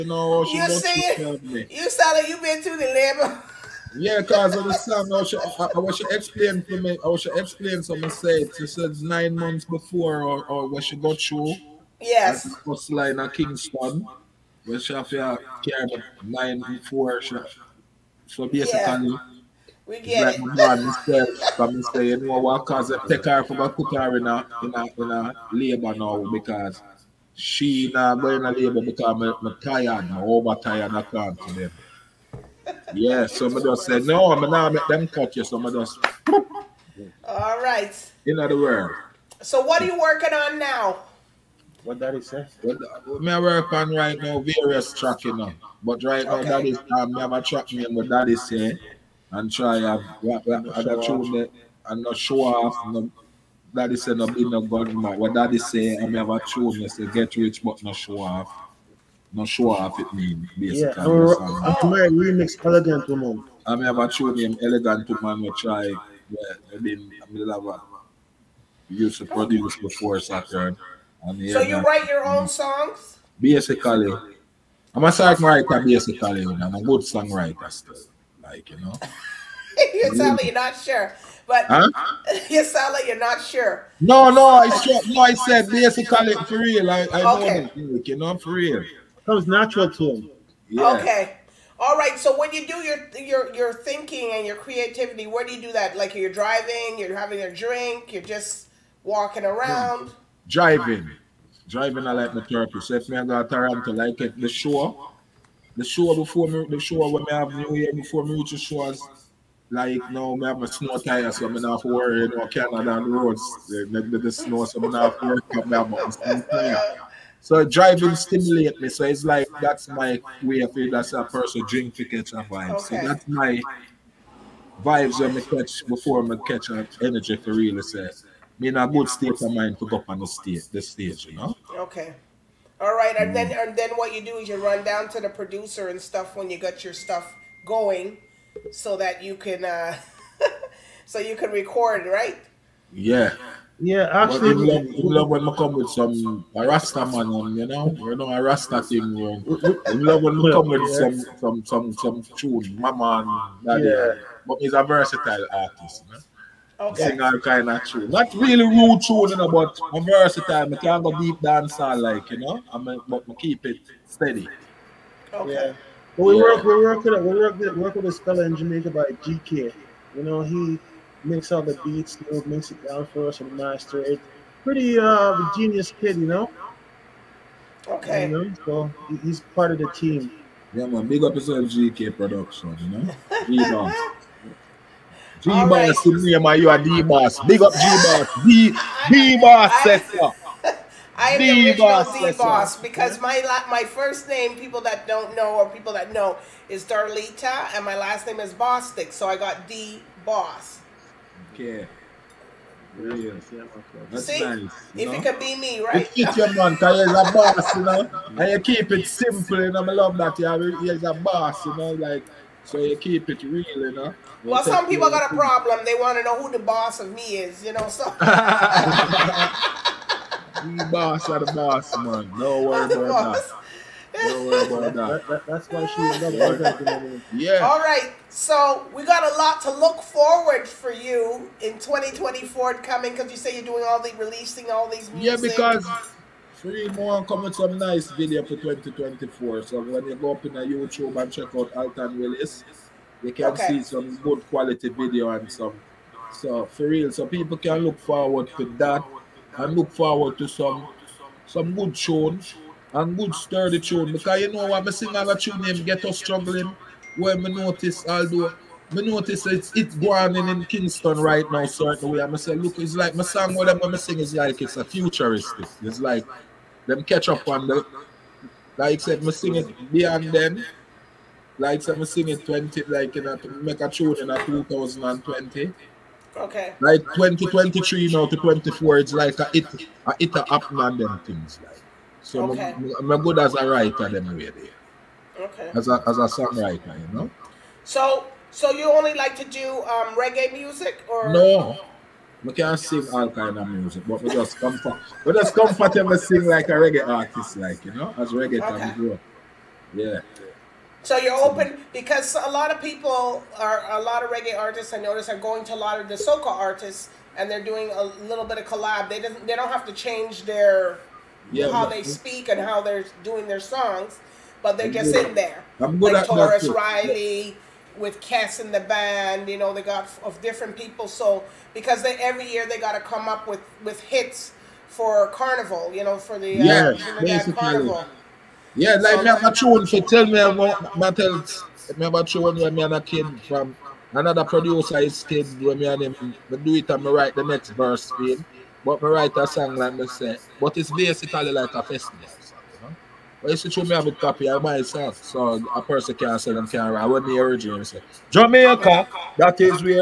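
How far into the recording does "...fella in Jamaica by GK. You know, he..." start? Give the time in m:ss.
2:48.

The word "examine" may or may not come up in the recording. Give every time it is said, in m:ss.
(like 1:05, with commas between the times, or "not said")
not said.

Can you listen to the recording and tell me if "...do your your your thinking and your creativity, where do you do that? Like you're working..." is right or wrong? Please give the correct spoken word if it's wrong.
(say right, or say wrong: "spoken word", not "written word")
wrong: "driving", not "working".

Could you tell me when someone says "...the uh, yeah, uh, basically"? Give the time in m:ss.
5:26.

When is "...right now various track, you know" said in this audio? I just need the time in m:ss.
0:43.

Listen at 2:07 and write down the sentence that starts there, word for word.
Say be in a good state of mind to go up on the stage, the stage, you know.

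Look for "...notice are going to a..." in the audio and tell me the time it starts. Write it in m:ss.
5:04.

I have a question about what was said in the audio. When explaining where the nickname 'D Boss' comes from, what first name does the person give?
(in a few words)
Darlita.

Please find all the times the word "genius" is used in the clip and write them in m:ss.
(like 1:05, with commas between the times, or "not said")
2:55.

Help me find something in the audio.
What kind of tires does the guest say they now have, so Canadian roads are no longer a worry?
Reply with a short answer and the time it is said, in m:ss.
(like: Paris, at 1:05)
Snow tires, at 1:50.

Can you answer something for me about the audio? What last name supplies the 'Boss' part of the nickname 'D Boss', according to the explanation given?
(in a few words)
Bostic.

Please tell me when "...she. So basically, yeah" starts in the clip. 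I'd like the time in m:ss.
0:17.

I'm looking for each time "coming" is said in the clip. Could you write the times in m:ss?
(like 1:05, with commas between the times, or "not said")
3:52, 3:57.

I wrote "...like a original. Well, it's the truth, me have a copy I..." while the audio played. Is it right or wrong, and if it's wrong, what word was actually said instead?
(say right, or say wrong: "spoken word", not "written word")
wrong: "festival", not "original".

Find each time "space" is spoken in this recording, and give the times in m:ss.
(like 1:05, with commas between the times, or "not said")
not said.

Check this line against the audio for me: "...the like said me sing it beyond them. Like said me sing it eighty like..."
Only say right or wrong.
wrong.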